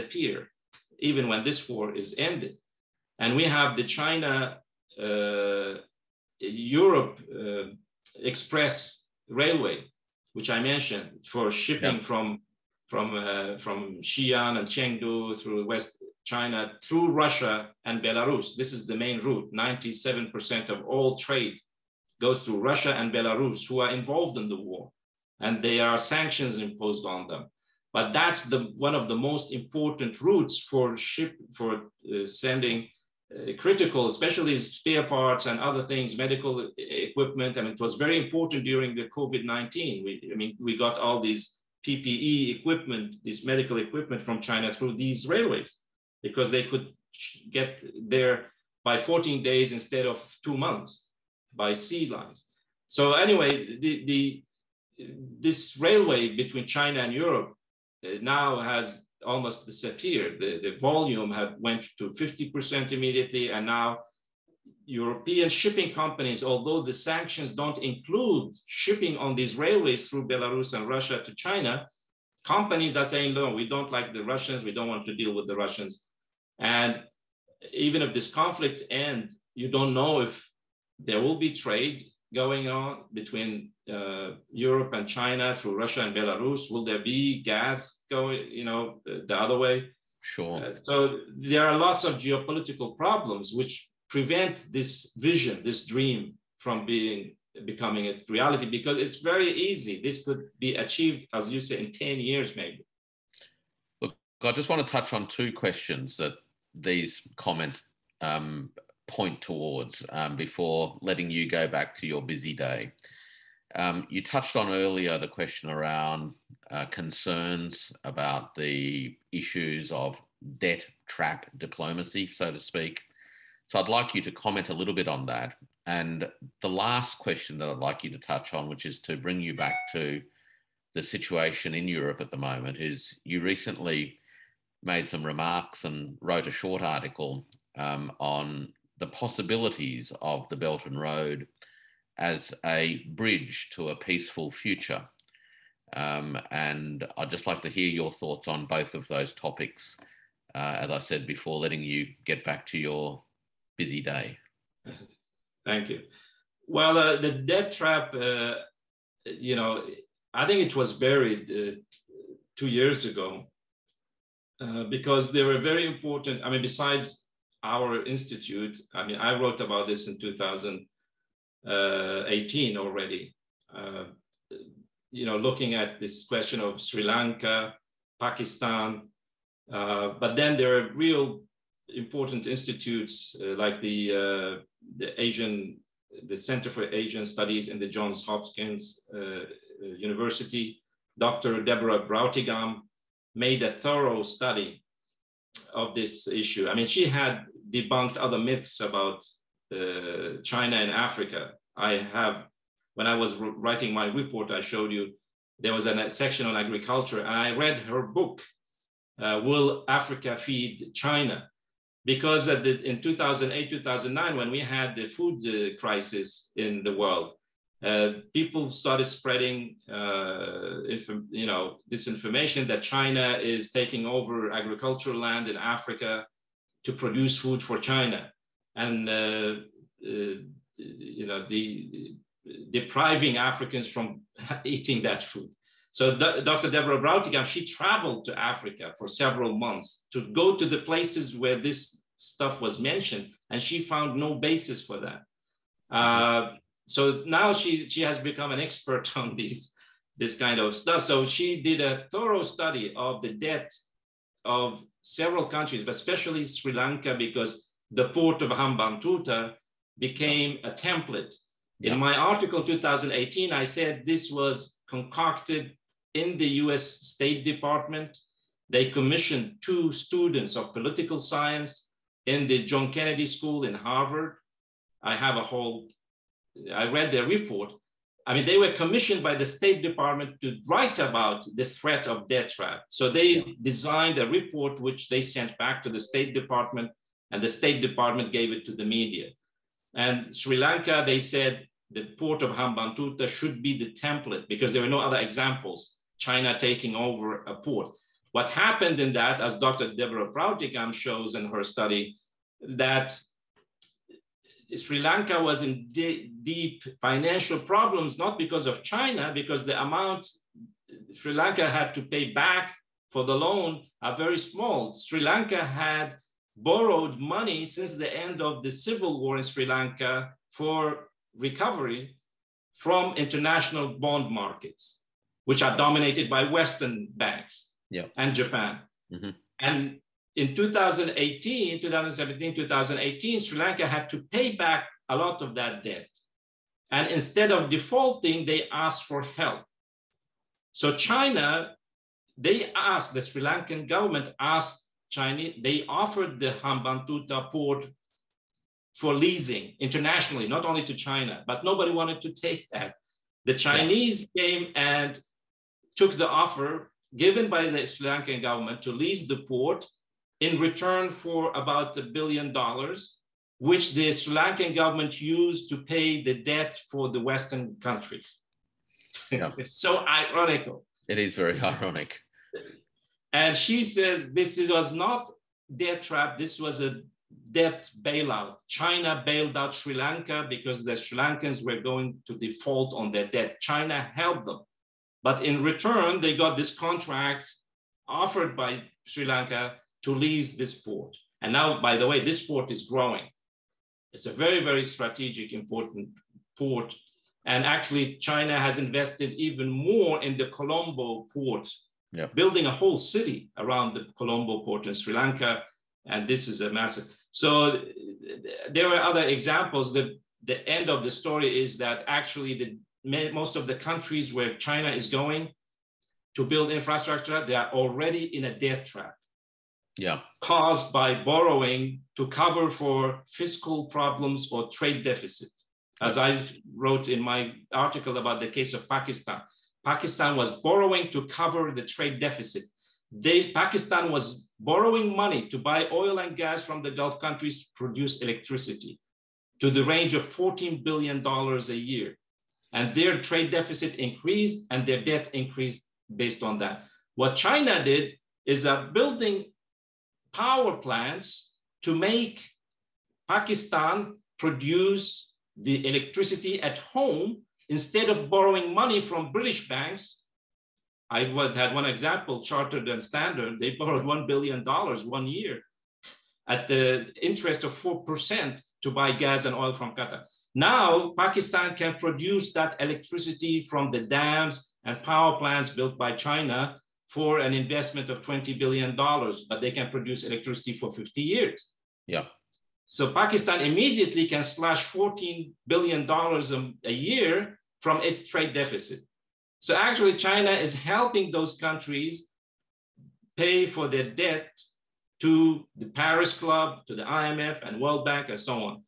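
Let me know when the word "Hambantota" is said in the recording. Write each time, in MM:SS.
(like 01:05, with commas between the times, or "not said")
04:18, 04:52, 05:46.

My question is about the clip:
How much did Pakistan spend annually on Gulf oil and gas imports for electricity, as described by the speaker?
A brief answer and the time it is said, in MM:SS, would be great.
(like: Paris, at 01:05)
$14 billion, at 07:20.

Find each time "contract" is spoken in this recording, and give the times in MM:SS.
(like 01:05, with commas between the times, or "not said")
06:26.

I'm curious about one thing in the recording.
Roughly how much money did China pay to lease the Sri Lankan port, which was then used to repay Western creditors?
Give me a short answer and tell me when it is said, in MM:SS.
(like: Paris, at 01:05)
about a billion dollars, at 06:01.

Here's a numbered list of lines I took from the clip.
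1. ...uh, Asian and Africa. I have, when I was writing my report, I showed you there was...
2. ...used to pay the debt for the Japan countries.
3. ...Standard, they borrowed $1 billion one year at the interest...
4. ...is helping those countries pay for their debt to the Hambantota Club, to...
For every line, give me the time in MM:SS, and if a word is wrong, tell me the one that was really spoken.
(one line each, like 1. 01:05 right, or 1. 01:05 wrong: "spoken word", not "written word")
1. 03:19 wrong: "China", not "Asian"
2. 06:05 wrong: "Western", not "Japan"
3. 07:43 right
4. 08:10 wrong: "Paris", not "Hambantota".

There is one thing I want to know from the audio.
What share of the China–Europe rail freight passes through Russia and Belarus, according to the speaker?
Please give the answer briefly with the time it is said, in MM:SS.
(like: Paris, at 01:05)
97%, at 00:19.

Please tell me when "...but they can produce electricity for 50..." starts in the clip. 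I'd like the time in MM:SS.
07:59.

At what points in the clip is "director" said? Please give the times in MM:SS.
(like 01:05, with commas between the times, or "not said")
not said.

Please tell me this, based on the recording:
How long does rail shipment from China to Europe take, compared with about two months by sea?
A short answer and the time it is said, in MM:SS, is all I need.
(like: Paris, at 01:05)
14 days, at 00:48.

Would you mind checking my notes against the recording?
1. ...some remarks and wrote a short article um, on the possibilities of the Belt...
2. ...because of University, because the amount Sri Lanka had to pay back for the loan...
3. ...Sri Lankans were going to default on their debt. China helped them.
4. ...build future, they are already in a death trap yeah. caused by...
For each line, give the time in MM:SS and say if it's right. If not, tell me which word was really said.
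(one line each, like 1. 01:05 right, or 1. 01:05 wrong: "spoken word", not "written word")
1. 02:15 right
2. 05:08 wrong: "China", not "University"
3. 06:20 right
4. 06:56 wrong: "infrastructure", not "future".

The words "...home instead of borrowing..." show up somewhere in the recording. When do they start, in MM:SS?
07:36.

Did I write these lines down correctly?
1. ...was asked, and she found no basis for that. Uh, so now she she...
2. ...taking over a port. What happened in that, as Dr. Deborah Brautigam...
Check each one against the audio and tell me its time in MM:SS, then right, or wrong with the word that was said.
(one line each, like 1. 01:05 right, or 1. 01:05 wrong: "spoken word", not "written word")
1. 04:02 wrong: "mentioned", not "asked"
2. 04:56 right.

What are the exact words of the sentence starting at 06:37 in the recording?
And actually, China has invested even more in the Colombo port, yeah.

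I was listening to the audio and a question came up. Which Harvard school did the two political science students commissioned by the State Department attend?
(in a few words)
John Kennedy School.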